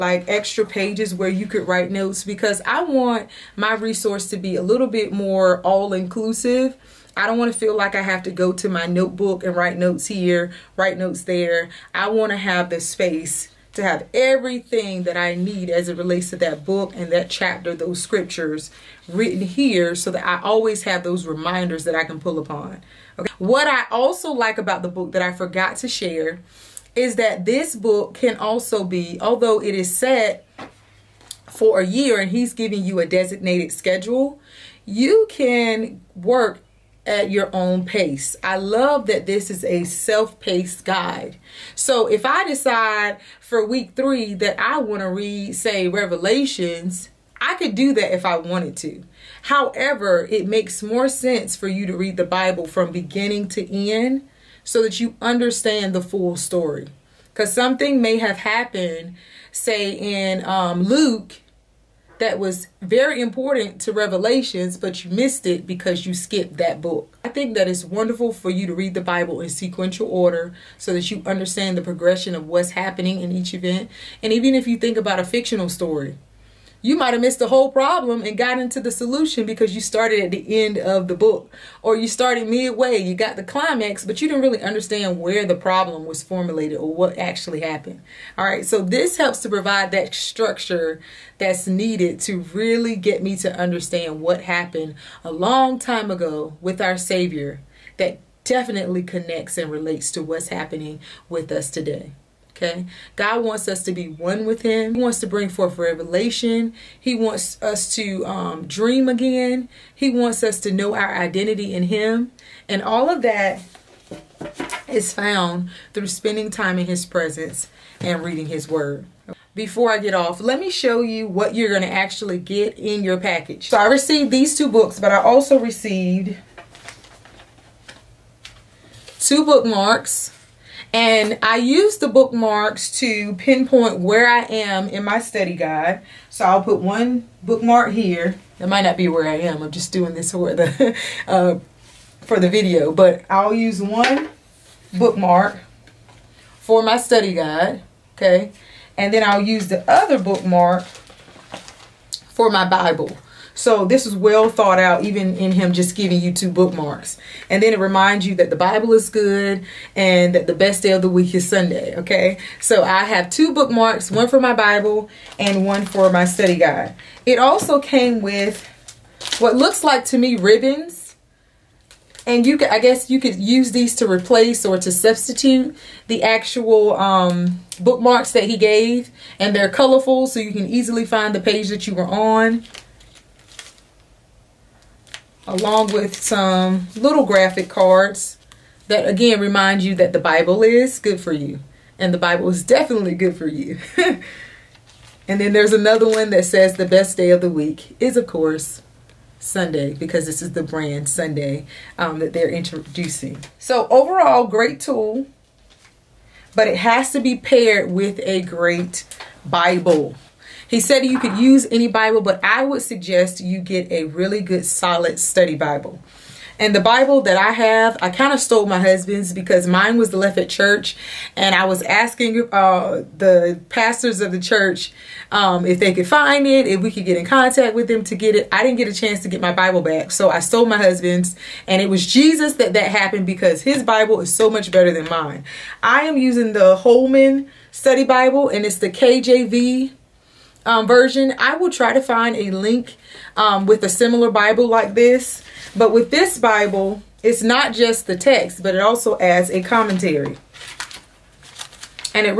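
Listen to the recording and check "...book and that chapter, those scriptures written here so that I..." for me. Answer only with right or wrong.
right.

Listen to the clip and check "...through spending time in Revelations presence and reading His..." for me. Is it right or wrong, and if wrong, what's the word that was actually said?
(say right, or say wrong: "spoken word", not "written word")
wrong: "His", not "Revelations".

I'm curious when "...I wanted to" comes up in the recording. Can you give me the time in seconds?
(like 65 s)
48 s.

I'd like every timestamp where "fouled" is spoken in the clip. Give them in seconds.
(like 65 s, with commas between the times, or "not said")
not said.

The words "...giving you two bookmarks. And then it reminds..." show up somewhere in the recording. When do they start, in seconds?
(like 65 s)
155 s.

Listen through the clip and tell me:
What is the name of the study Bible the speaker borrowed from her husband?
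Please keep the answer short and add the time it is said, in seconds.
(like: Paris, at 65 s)
Holman Study Bible, at 236 s.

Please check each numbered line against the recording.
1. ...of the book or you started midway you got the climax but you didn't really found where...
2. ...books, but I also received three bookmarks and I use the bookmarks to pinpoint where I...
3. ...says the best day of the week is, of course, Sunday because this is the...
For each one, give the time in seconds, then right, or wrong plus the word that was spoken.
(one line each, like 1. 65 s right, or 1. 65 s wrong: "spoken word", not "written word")
1. 80 s wrong: "understand", not "found"
2. 124 s wrong: "two", not "three"
3. 196 s right.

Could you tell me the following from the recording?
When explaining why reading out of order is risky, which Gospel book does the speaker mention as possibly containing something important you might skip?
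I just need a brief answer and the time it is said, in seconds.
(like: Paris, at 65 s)
Luke, at 60 s.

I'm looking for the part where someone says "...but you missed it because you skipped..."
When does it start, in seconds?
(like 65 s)
64 s.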